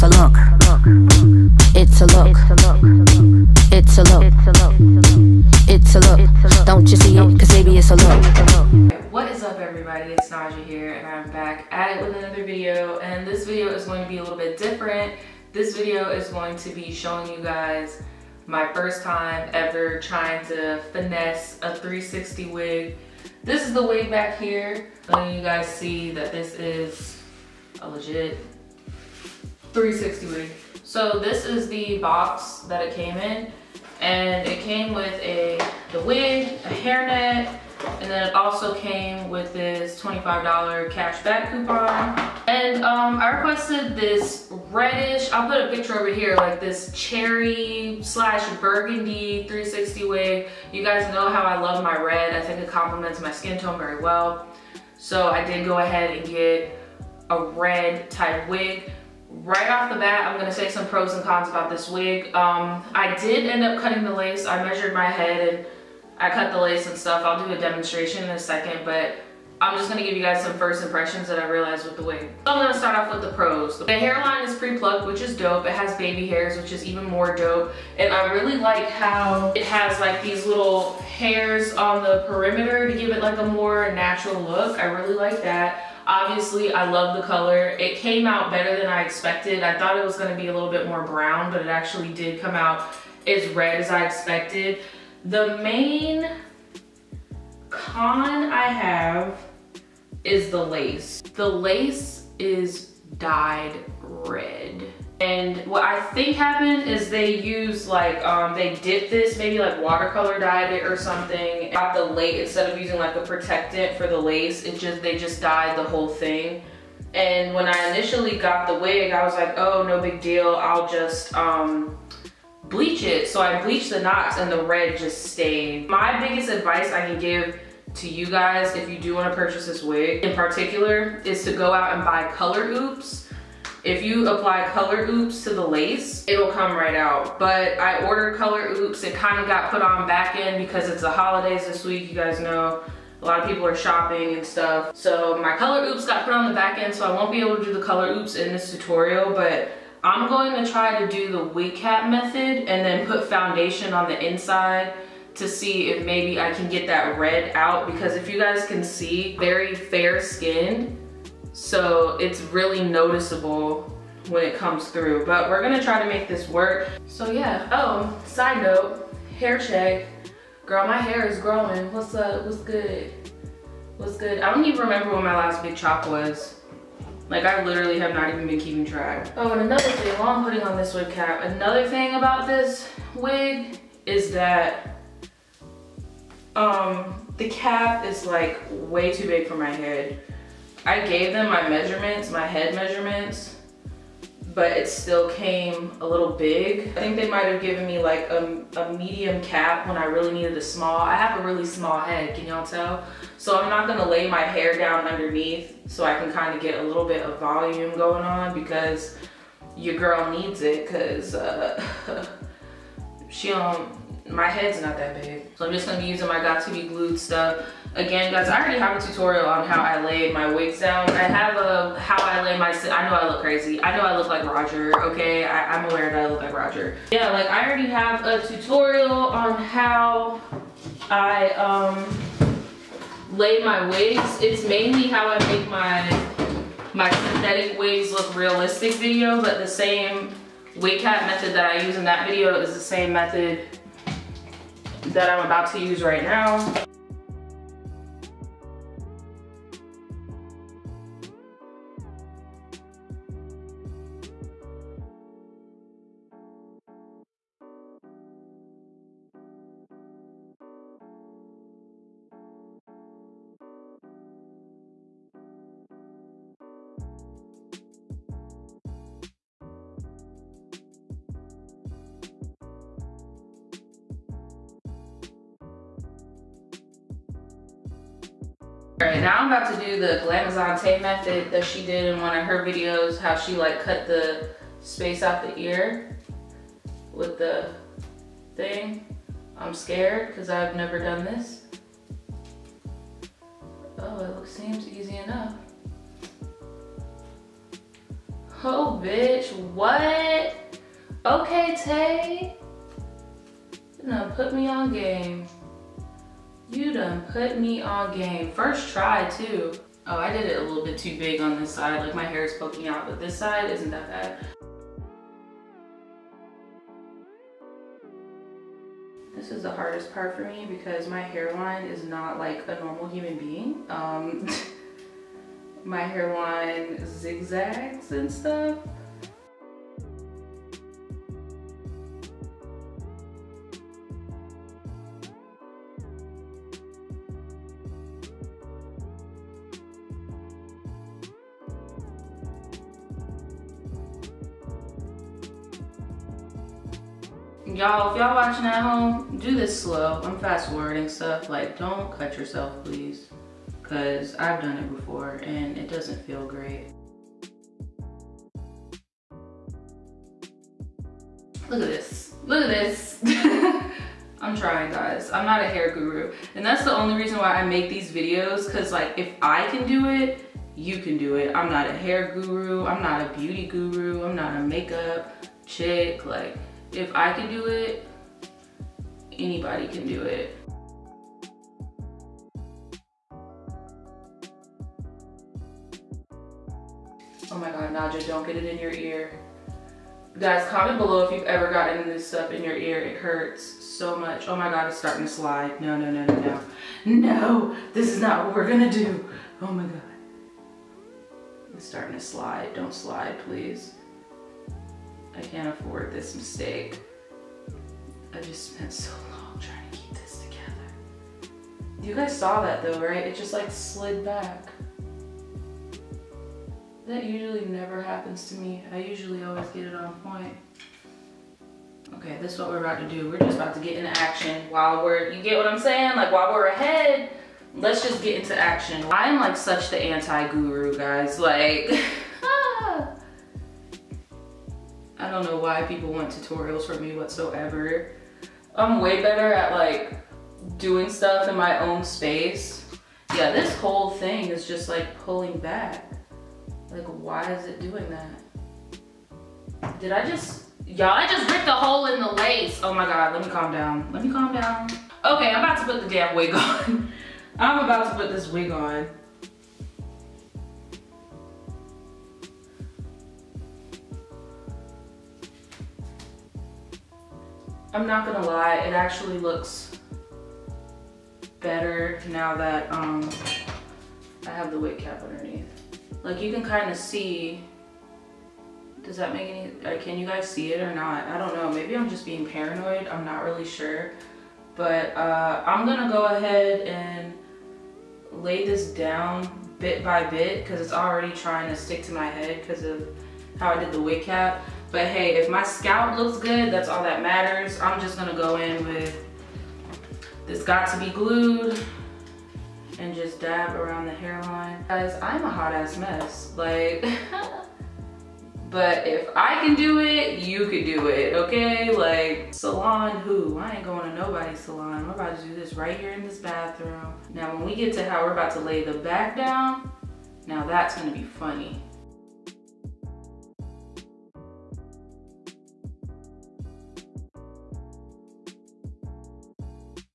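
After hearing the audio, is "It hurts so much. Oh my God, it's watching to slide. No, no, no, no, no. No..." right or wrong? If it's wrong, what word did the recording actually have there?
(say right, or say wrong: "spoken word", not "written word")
wrong: "starting", not "watching".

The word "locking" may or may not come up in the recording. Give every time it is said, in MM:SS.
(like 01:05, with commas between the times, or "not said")
not said.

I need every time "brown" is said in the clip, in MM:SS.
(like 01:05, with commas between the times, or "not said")
01:31.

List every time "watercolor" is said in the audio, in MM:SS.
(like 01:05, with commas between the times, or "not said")
01:49.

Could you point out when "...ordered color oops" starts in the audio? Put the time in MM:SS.
02:18.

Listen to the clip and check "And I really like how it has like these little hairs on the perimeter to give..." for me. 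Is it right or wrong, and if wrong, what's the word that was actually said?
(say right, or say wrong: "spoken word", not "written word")
right.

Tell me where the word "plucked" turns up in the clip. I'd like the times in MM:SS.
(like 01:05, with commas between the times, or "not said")
01:14.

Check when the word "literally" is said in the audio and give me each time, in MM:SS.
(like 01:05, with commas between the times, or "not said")
02:57.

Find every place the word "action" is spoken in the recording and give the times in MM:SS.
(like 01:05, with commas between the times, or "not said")
07:04, 07:08.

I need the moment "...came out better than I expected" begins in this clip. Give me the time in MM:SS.
01:27.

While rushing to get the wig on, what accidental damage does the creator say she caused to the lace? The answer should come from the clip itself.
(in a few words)
Ripped a hole.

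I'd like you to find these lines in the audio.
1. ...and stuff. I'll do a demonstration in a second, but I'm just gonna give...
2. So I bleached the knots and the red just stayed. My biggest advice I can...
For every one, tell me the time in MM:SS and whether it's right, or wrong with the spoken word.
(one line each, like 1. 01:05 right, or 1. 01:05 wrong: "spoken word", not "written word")
1. 01:06 right
2. 02:03 right.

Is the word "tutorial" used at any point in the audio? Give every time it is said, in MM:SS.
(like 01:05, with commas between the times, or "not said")
02:28, 03:39, 03:48, 07:16.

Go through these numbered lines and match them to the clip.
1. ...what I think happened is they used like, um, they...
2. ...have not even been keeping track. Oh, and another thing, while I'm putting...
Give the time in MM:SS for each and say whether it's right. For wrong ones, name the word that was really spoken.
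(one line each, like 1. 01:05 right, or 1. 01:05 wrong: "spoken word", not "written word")
1. 01:45 right
2. 02:57 right.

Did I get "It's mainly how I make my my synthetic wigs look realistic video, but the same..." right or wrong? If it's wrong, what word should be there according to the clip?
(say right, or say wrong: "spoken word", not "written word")
right.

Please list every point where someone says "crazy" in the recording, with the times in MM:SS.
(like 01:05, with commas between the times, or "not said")
03:43.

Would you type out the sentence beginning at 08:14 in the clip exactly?
But hey, if my scalp looks good, that's all that matters.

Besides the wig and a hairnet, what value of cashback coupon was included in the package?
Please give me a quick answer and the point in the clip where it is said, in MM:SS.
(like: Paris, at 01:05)
$25, at 00:40.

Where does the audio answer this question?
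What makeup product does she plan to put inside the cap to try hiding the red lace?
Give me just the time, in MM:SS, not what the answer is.
02:33.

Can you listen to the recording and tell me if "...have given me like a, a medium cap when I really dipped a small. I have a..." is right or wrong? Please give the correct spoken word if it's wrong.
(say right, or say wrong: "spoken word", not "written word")
wrong: "needed", not "dipped".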